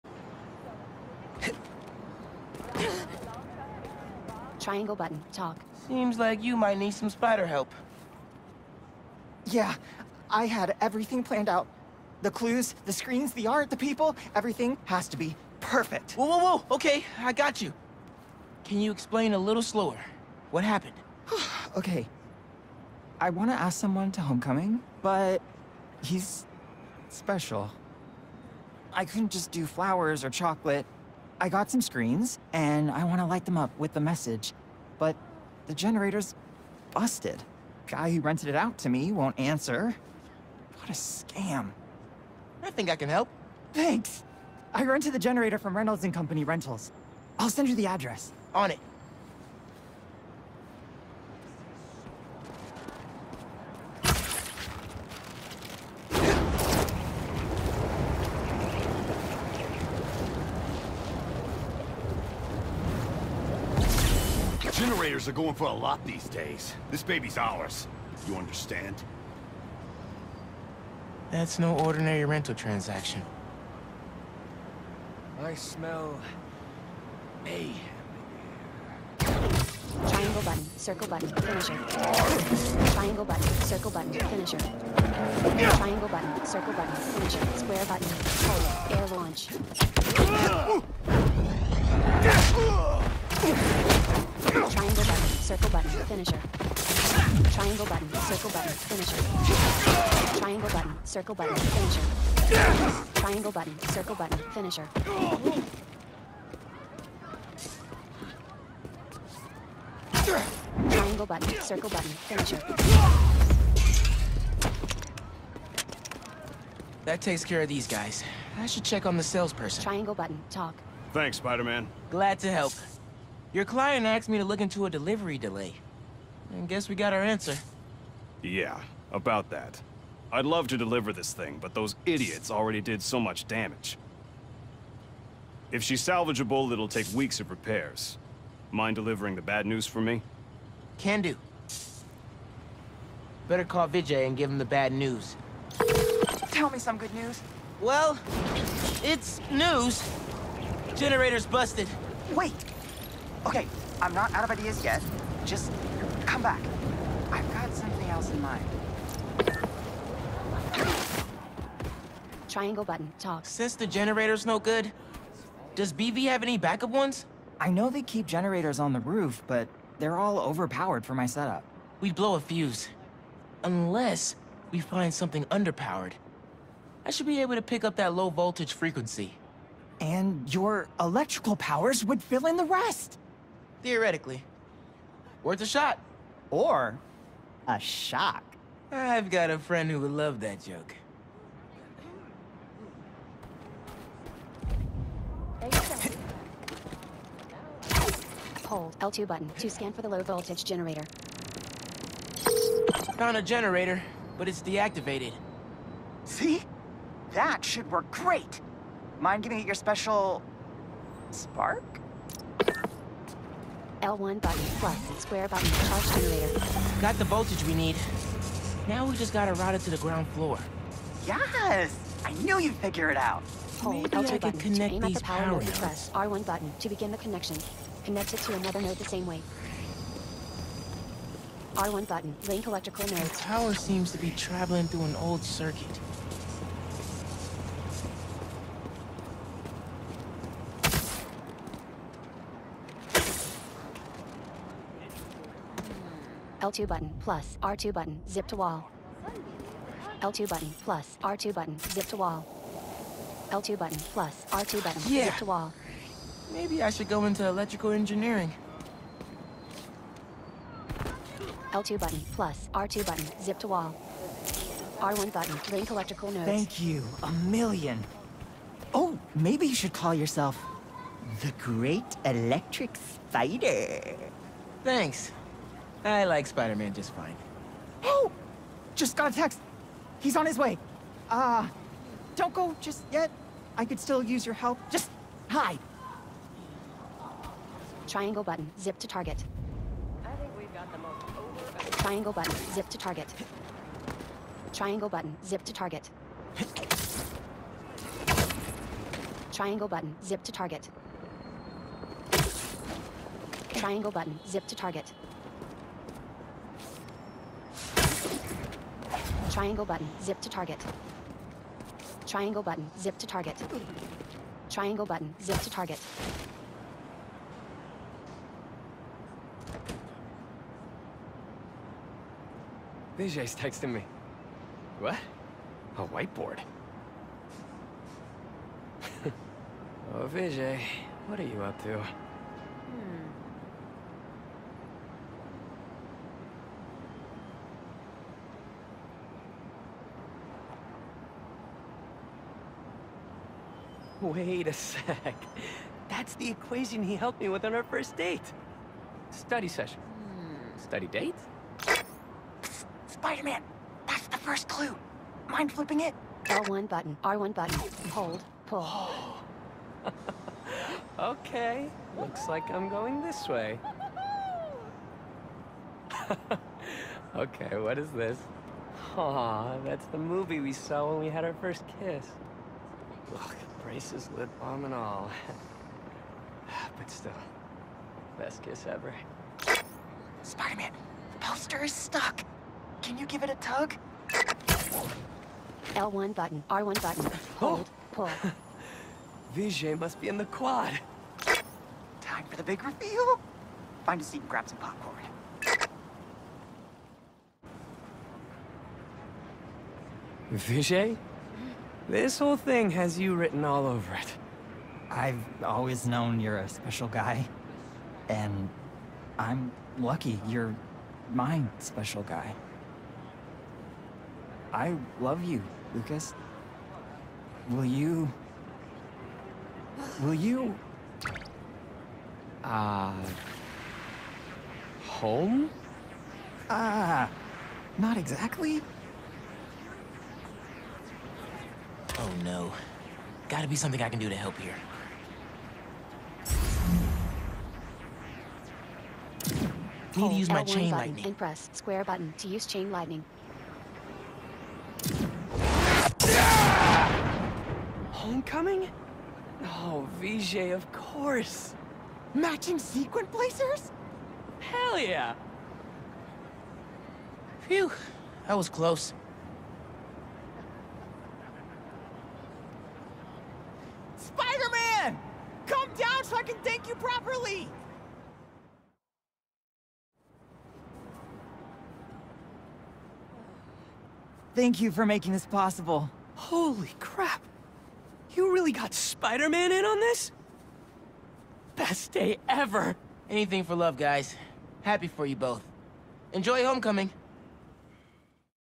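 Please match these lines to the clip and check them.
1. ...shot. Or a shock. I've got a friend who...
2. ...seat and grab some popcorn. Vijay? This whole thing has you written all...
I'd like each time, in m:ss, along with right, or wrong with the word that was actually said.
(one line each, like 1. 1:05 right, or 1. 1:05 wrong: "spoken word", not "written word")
1. 3:05 right
2. 6:34 right.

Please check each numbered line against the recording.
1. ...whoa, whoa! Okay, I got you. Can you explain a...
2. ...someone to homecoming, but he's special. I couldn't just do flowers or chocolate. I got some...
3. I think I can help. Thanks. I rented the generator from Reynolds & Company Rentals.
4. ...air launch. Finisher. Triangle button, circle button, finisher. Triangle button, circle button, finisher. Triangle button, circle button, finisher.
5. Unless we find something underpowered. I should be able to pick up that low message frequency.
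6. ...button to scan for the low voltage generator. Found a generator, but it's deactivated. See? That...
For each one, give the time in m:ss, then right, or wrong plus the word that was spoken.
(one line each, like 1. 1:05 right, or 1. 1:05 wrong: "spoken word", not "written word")
1. 0:16 right
2. 0:23 right
3. 0:42 right
4. 1:30 right
5. 2:53 wrong: "voltage", not "message"
6. 3:19 right.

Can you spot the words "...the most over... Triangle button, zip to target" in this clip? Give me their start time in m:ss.
4:50.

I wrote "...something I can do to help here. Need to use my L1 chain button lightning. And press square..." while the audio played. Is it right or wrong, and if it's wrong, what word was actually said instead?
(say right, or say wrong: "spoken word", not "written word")
right.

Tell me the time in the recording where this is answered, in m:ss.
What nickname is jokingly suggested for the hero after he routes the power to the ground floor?
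4:31.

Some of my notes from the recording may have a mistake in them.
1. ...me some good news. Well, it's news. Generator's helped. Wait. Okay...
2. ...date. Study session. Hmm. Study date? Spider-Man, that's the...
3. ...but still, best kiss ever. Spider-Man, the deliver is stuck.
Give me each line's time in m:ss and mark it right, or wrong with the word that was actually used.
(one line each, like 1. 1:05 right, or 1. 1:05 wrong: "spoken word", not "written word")
1. 2:26 wrong: "busted", not "helped"
2. 5:48 right
3. 6:16 wrong: "poster", not "deliver".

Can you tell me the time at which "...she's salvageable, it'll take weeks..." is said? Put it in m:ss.
2:15.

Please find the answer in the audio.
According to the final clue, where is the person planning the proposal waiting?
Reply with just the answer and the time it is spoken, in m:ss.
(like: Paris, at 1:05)
The quad, at 6:30.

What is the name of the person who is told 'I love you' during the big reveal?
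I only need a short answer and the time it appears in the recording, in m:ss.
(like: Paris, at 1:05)
Lucas, at 6:55.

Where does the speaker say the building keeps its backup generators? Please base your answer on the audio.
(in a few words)
On the roof.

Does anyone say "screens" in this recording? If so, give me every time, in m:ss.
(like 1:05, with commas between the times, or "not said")
0:12, 0:31.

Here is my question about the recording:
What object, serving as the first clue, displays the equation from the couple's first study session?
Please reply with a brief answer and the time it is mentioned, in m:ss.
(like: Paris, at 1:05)
A whiteboard, at 5:26.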